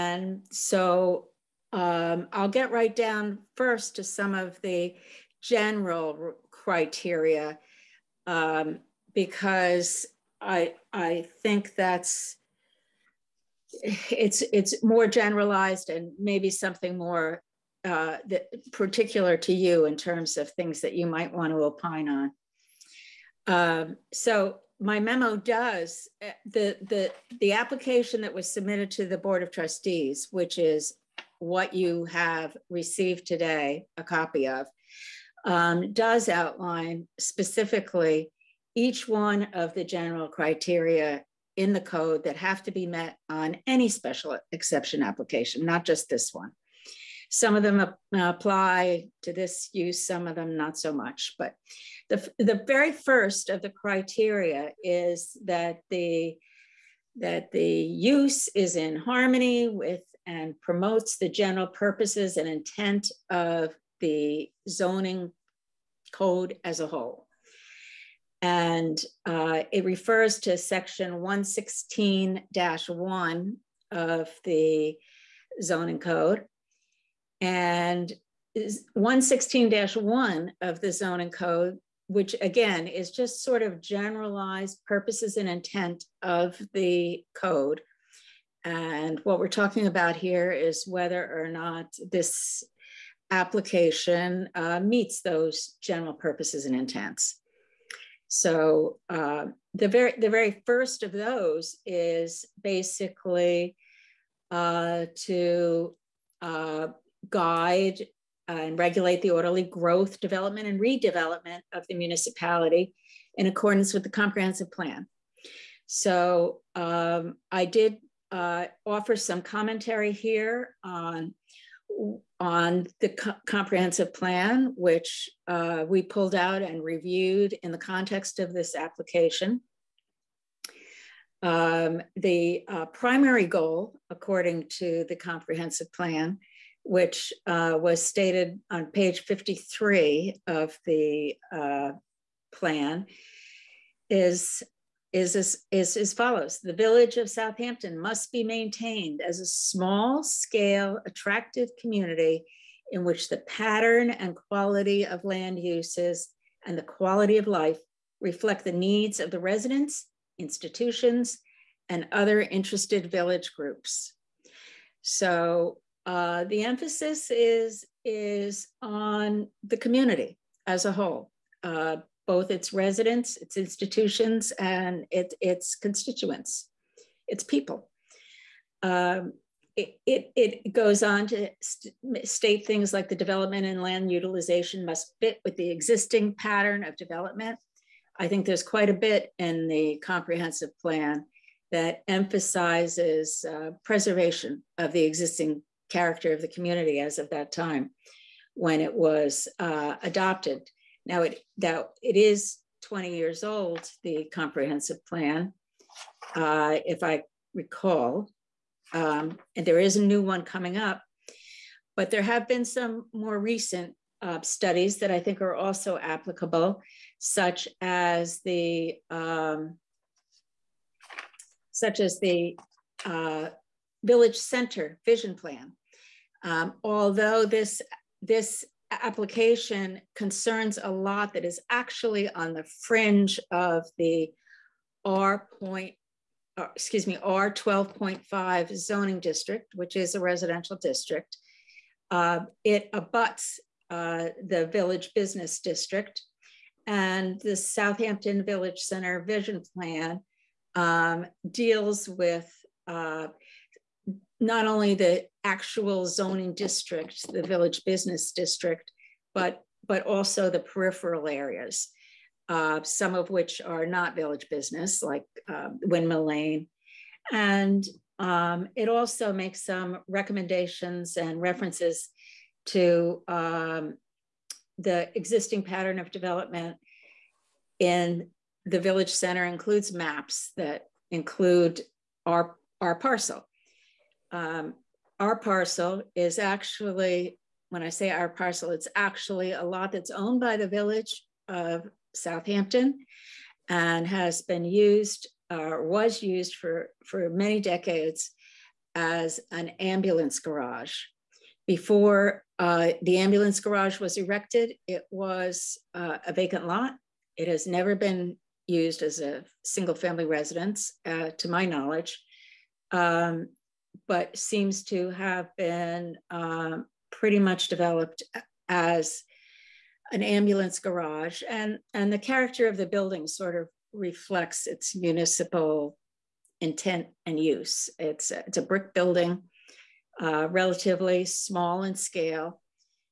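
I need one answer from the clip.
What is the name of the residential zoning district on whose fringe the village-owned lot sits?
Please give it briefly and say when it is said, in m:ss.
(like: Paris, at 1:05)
R 12.5, at 3:57.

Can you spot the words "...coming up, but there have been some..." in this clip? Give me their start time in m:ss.
3:30.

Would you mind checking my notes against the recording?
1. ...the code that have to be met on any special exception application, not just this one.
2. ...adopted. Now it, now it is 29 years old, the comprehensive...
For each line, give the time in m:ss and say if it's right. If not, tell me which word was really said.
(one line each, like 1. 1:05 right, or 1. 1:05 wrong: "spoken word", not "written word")
1. 0:41 right
2. 3:20 wrong: "20", not "29".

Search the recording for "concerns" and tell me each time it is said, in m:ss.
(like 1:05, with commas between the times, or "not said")
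3:50.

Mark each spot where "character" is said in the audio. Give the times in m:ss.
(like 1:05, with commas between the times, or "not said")
3:15, 5:22.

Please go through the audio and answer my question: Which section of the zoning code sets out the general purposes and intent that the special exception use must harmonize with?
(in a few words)
116-1.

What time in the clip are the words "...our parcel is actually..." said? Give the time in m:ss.
4:45.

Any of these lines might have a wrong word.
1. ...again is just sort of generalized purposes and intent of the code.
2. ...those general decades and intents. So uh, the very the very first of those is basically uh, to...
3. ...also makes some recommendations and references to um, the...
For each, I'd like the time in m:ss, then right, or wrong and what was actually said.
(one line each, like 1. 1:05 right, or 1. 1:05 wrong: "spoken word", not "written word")
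1. 1:22 right
2. 1:35 wrong: "purposes", not "decades"
3. 4:28 right.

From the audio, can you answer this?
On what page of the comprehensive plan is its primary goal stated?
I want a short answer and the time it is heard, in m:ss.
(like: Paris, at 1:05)
53, at 2:18.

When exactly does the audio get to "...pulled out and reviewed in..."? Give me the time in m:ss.
2:06.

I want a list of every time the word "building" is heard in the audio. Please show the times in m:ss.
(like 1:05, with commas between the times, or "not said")
5:22, 5:28.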